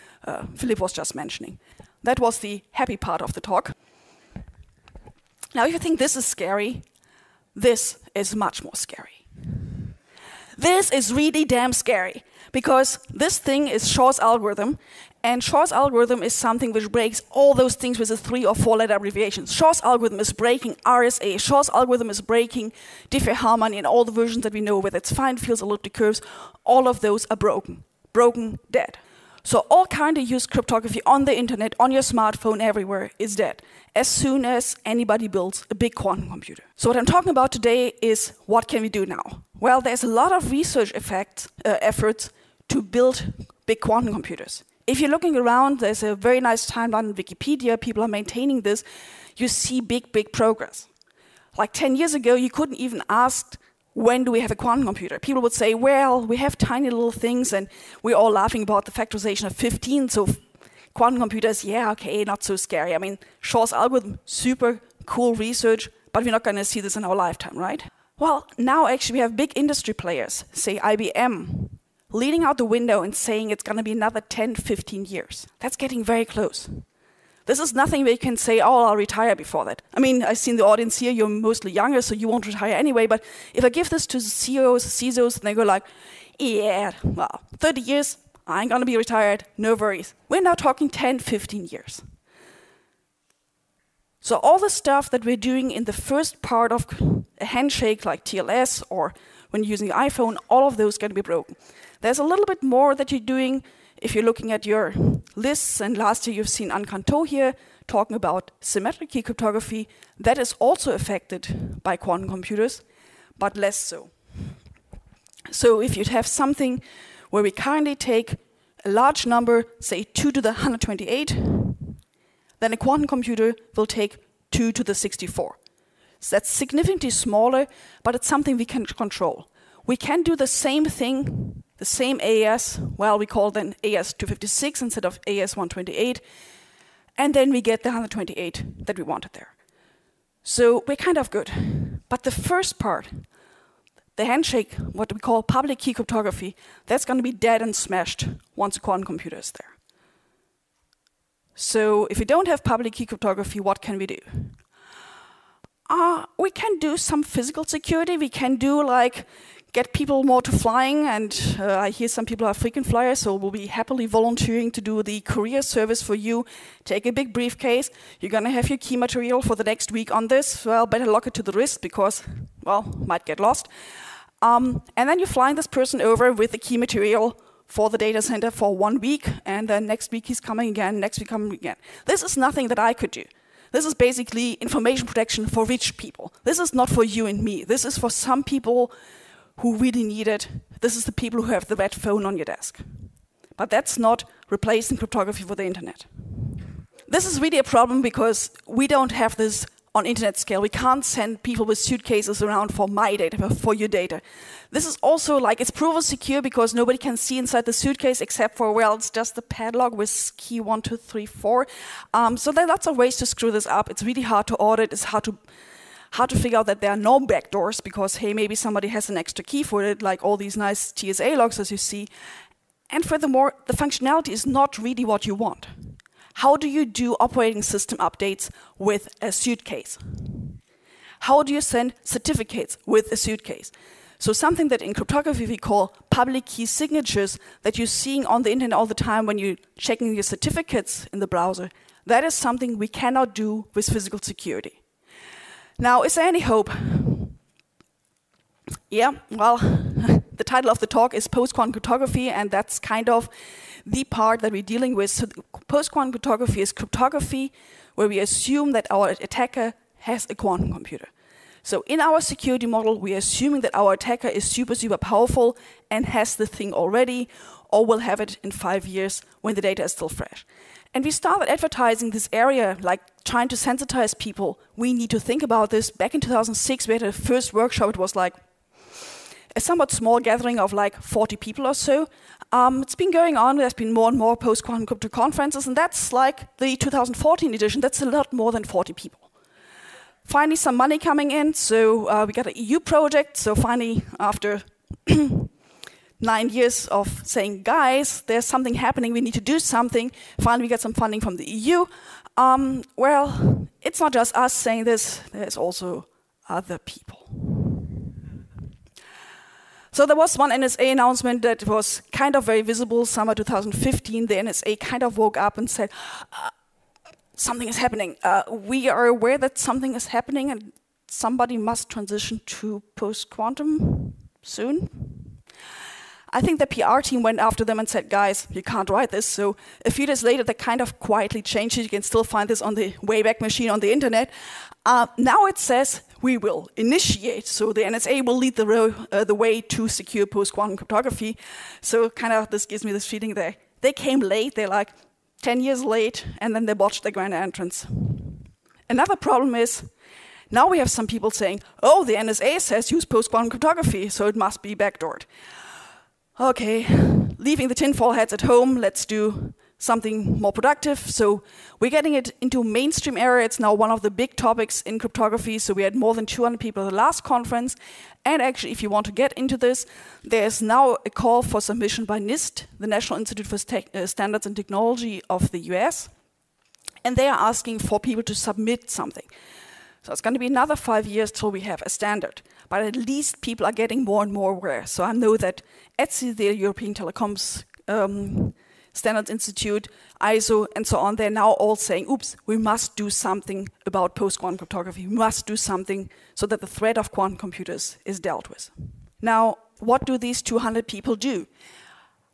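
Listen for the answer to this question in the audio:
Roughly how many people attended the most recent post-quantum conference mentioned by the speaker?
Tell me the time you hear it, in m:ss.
6:05.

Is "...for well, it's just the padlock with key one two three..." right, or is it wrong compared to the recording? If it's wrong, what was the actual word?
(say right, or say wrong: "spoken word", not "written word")
right.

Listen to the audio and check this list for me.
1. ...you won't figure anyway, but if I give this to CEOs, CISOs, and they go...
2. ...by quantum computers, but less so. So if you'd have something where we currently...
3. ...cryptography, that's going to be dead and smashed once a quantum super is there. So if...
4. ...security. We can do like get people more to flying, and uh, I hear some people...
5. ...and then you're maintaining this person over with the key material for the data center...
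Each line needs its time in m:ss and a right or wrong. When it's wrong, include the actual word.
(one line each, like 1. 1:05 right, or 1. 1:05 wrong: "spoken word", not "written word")
1. 1:22 wrong: "retire", not "figure"
2. 1:51 right
3. 2:25 wrong: "computer", not "super"
4. 2:37 right
5. 2:54 wrong: "flying", not "maintaining".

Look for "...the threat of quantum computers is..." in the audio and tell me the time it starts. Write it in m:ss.
6:36.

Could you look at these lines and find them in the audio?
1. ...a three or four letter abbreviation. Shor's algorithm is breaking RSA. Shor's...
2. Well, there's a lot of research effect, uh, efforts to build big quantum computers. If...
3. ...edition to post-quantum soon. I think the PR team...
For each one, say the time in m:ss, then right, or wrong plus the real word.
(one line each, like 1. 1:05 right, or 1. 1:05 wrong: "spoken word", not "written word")
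1. 0:18 right
2. 0:39 right
3. 5:21 wrong: "transition", not "edition".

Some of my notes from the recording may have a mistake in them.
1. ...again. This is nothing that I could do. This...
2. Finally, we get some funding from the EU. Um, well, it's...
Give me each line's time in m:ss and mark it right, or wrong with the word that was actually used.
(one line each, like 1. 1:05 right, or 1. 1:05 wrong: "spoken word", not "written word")
1. 3:01 right
2. 5:00 right.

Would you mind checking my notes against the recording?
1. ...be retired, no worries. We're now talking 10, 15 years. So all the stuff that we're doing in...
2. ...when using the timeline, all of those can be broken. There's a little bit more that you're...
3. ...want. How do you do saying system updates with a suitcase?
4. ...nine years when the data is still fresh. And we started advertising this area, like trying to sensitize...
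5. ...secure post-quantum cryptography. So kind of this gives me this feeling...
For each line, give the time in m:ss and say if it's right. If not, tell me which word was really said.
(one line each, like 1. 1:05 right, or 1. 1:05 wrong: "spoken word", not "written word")
1. 1:28 right
2. 1:39 wrong: "iPhone", not "timeline"
3. 3:45 wrong: "operating", not "saying"
4. 4:28 wrong: "five", not "nine"
5. 5:39 right.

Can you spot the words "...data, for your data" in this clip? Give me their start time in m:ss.
3:23.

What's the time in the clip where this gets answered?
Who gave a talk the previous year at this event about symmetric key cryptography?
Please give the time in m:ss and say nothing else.
1:46.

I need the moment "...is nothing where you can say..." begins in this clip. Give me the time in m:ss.
1:17.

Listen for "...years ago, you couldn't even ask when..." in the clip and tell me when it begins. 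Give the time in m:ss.
0:51.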